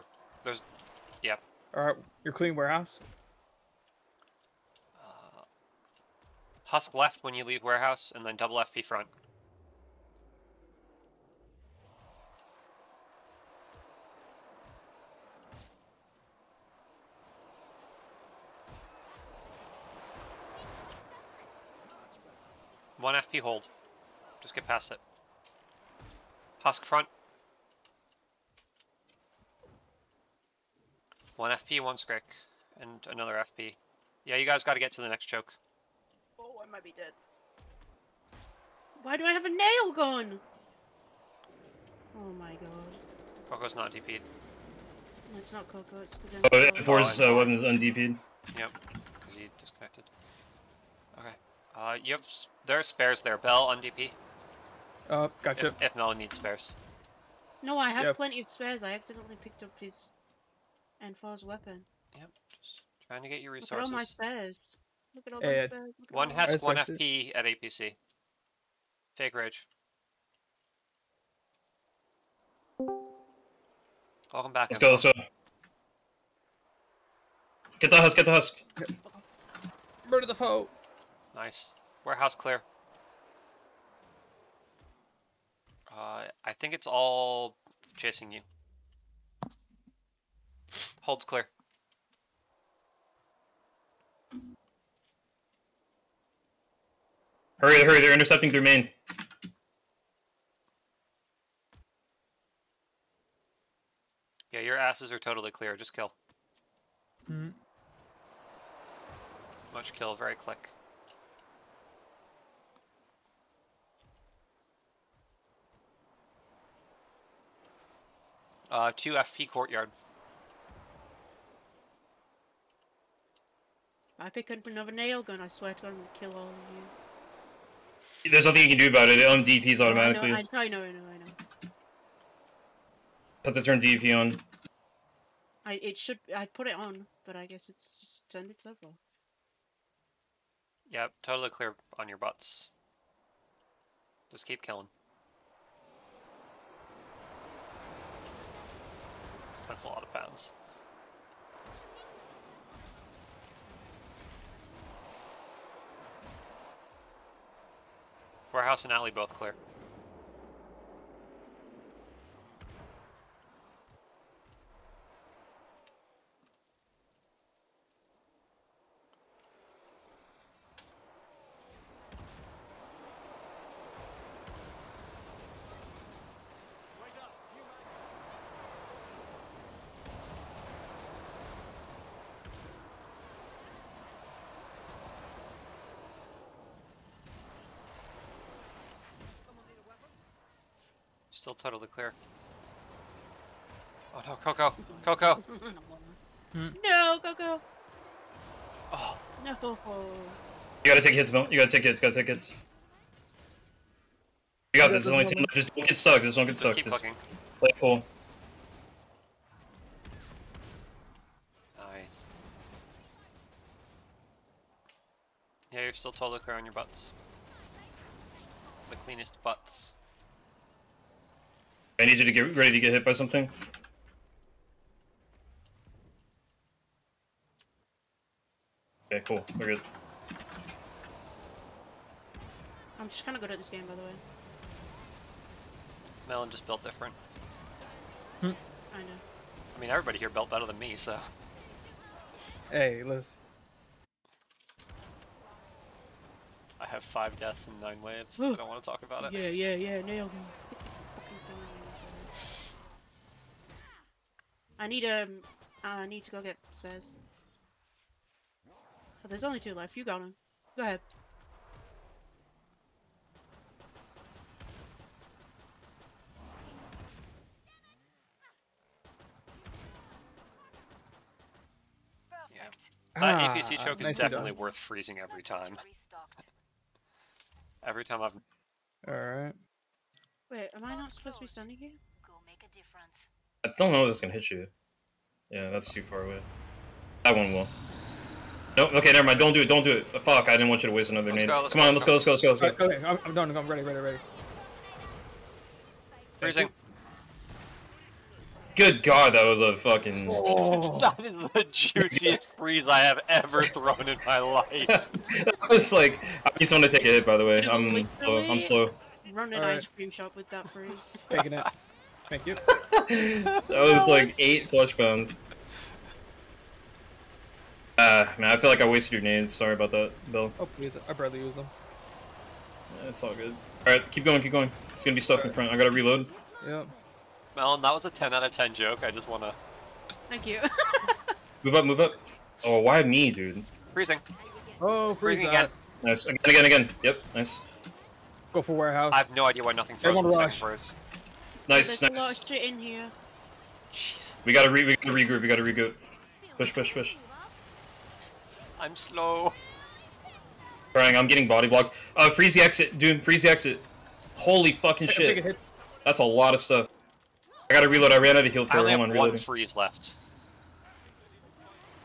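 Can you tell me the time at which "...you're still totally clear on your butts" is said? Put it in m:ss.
3:35.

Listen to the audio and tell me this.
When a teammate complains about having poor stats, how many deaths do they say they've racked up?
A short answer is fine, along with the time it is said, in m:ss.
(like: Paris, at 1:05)
5, at 4:07.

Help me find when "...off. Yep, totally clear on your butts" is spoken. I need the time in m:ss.
2:18.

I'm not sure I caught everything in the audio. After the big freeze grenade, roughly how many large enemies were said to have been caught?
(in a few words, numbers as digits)
8.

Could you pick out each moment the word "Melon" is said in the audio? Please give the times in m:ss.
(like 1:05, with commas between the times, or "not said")
3:56, 5:27.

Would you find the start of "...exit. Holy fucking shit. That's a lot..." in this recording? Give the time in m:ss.
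5:53.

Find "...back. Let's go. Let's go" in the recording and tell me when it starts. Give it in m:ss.
1:14.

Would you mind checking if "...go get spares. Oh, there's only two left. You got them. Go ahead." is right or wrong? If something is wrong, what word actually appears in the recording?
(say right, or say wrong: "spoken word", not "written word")
right.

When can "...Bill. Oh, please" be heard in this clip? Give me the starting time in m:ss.
5:20.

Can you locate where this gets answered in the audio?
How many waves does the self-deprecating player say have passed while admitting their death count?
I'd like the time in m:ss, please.
4:07.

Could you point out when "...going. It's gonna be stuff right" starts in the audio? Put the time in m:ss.
5:24.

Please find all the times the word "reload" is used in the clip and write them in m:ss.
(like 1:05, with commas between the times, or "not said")
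5:25, 5:57.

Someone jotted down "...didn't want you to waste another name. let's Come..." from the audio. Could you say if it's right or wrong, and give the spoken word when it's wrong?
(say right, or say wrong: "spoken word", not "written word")
right.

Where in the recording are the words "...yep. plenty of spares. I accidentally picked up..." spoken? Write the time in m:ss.
0:58.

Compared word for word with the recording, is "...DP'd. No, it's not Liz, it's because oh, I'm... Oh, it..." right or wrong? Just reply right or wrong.
wrong.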